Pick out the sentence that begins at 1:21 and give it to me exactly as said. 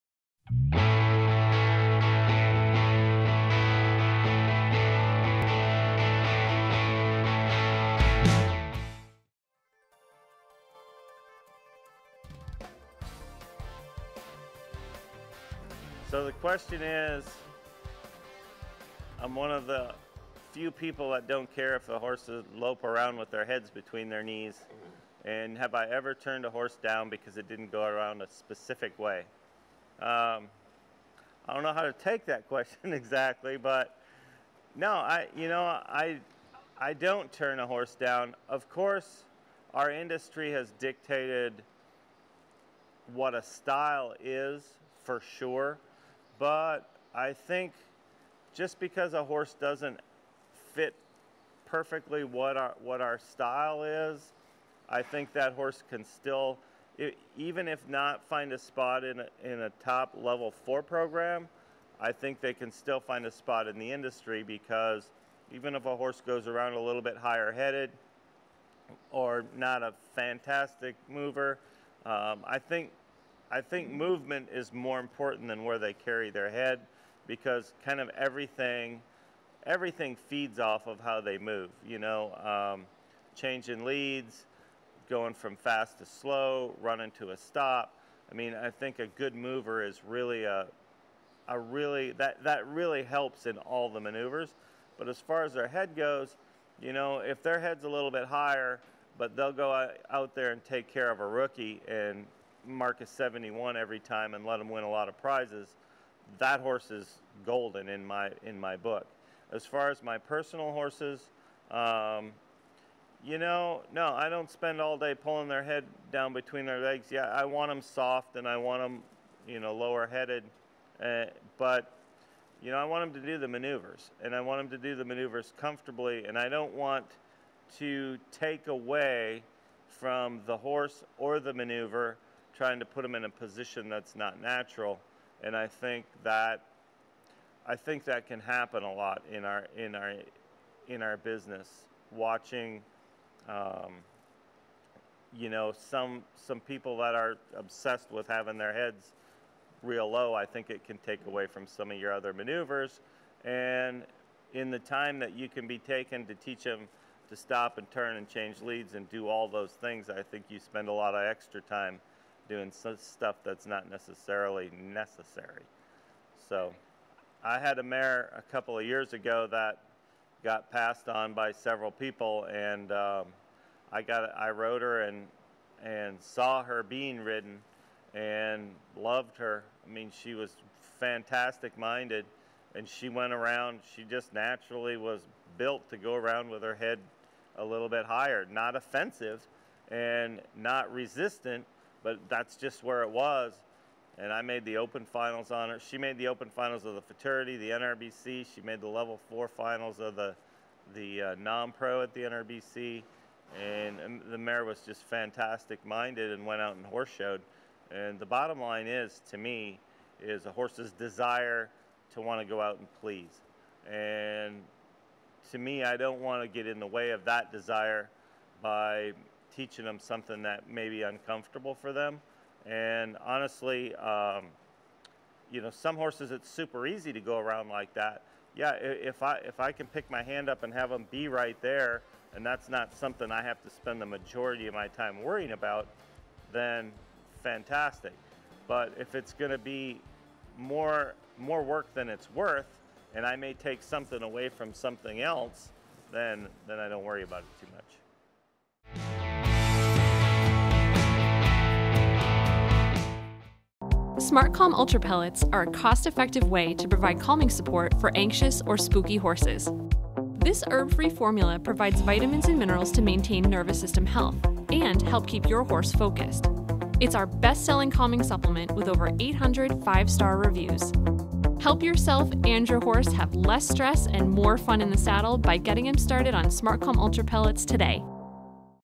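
You know, um, change in leads, going from fast to slow, running to a stop.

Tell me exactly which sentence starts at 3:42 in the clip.
And honestly, um, you know, some horses it's super easy to go around like that.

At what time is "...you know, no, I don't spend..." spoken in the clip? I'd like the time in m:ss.
1:53.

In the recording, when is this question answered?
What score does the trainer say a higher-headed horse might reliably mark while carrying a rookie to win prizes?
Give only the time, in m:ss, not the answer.
1:43.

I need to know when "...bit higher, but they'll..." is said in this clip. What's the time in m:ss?
1:38.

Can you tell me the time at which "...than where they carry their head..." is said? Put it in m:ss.
1:15.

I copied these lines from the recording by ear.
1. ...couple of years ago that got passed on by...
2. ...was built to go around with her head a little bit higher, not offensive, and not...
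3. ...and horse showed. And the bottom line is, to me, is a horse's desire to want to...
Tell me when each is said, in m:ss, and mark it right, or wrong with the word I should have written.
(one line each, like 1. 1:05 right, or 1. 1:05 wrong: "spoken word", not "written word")
1. 2:48 right
2. 3:04 right
3. 3:26 right.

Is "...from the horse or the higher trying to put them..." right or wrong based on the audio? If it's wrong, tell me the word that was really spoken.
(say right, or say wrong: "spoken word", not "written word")
wrong: "maneuver", not "higher".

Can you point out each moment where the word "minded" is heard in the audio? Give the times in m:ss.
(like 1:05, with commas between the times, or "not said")
3:01, 3:25.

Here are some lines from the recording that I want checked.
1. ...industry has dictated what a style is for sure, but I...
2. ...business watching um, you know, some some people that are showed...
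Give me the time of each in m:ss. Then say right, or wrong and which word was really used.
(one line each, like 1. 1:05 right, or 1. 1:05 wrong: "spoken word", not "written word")
1. 0:39 right
2. 2:21 wrong: "obsessed", not "showed".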